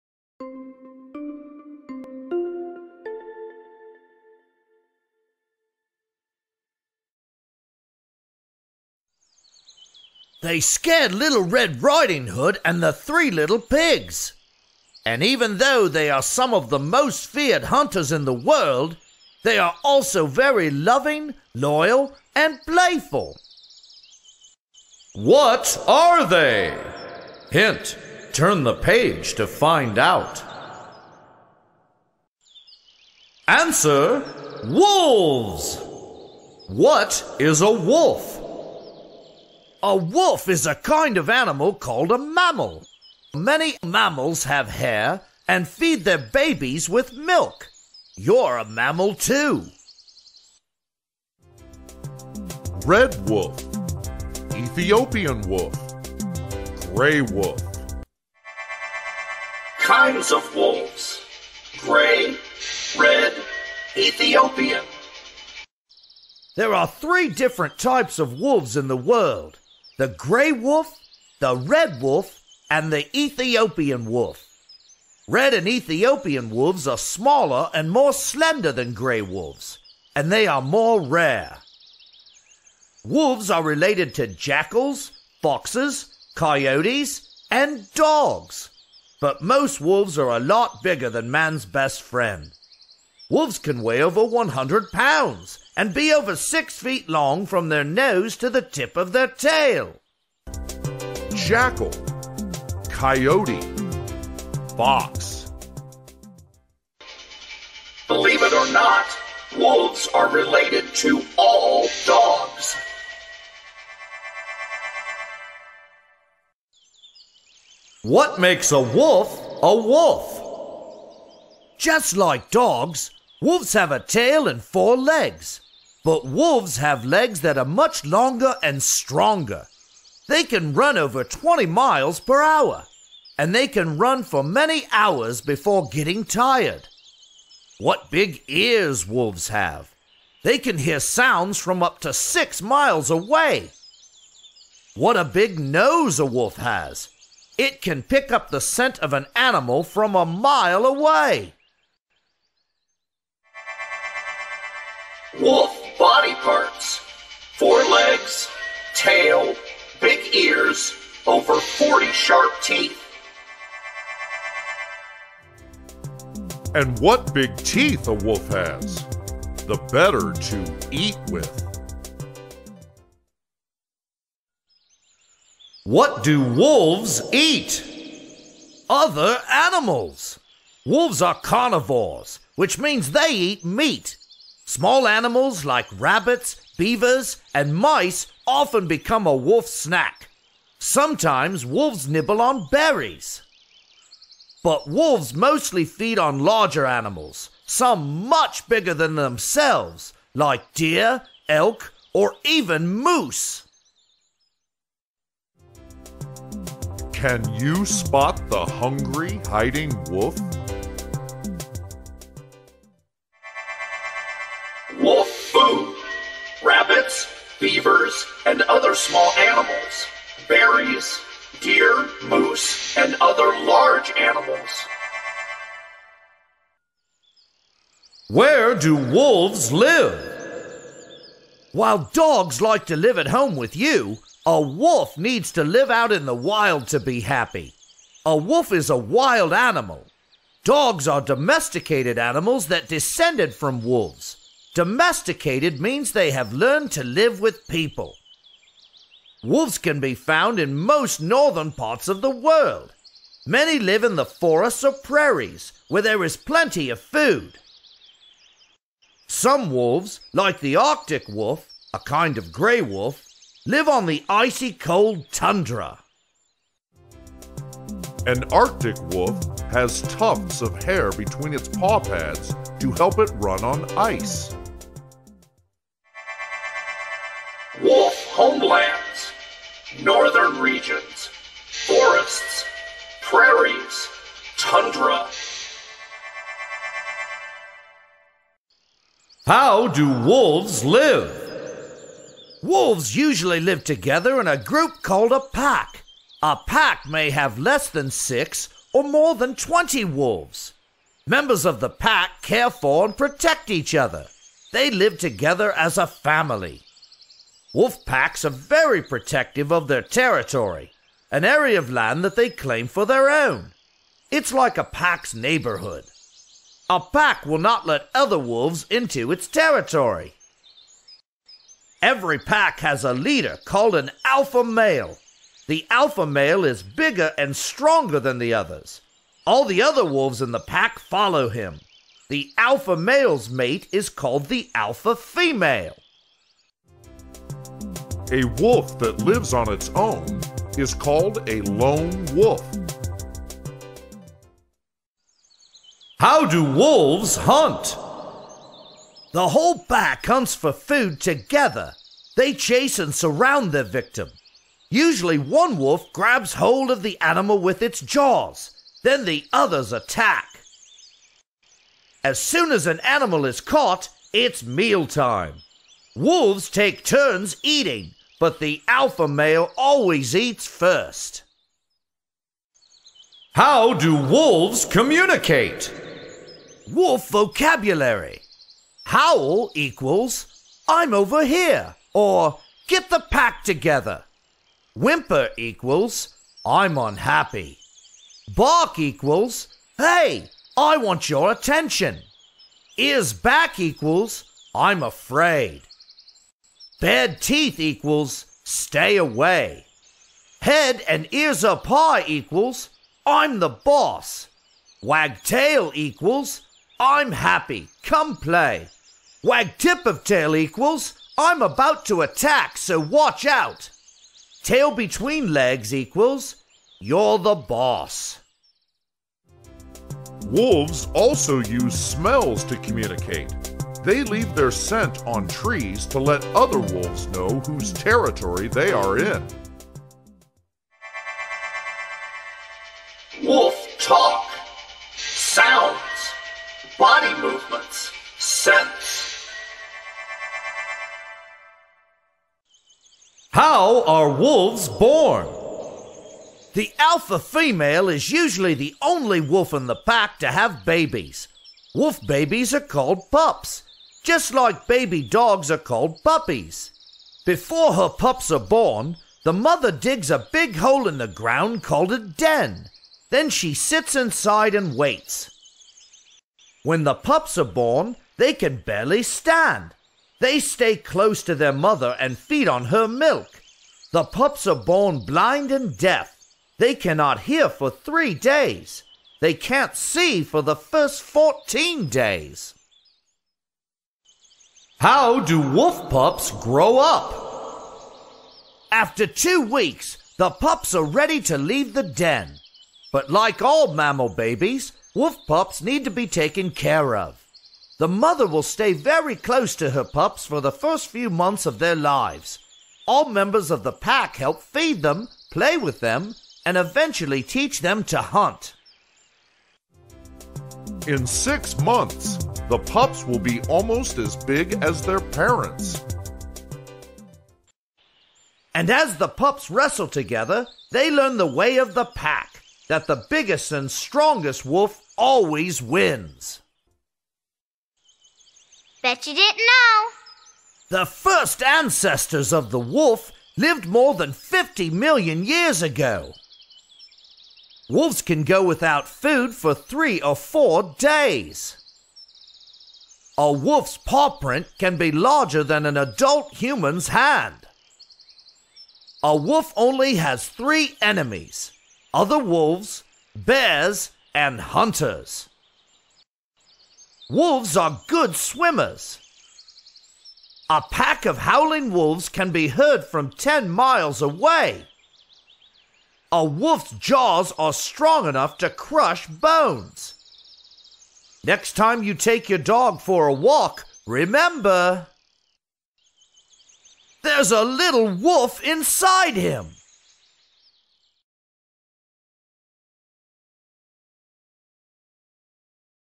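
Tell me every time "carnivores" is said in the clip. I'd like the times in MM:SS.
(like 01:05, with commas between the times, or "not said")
03:01.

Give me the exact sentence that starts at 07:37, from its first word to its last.
Before her pups are born, the mother digs a big hole in the ground called a den.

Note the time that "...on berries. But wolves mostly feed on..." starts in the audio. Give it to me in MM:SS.
03:12.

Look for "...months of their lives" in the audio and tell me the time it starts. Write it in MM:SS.
08:21.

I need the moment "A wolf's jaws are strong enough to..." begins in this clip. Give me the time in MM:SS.
09:26.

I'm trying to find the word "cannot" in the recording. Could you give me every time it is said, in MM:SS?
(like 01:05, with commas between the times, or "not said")
07:56.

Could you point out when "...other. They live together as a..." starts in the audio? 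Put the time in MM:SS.
05:03.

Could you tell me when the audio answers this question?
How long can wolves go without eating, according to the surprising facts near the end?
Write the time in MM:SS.
08:59.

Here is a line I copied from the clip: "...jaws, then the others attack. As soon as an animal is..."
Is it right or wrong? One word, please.
right.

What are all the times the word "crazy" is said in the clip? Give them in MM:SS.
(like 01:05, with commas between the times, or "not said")
not said.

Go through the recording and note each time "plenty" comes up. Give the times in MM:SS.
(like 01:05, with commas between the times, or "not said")
04:16.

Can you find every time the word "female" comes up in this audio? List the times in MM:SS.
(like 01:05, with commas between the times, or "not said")
05:35, 07:27.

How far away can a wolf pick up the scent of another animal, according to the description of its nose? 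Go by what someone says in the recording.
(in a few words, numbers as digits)
a mile.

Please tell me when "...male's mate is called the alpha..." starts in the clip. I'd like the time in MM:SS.
05:32.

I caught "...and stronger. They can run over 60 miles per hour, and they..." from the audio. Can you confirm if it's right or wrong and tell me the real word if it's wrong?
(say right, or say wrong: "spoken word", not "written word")
wrong: "20", not "60".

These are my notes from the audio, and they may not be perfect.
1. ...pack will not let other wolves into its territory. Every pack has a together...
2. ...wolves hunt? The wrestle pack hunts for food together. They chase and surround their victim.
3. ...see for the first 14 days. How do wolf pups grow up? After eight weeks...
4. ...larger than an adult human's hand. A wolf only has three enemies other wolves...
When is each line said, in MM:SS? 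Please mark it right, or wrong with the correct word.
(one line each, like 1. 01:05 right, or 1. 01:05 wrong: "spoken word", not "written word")
1. 05:16 wrong: "leader", not "together"
2. 05:46 wrong: "whole", not "wrestle"
3. 07:59 wrong: "two", not "eight"
4. 09:05 right.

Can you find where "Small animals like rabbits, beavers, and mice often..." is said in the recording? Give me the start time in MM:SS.
03:04.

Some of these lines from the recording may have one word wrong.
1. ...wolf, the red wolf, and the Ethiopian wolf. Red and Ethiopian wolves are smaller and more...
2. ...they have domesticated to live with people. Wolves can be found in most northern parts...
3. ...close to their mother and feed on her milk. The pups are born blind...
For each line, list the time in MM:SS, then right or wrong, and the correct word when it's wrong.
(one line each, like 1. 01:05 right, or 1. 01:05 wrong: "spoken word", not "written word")
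1. 01:10 right
2. 04:06 wrong: "learned", not "domesticated"
3. 07:50 right.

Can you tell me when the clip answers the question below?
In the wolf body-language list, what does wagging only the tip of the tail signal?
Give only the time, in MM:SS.
06:51.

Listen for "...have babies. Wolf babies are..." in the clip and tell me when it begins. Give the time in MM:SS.
07:30.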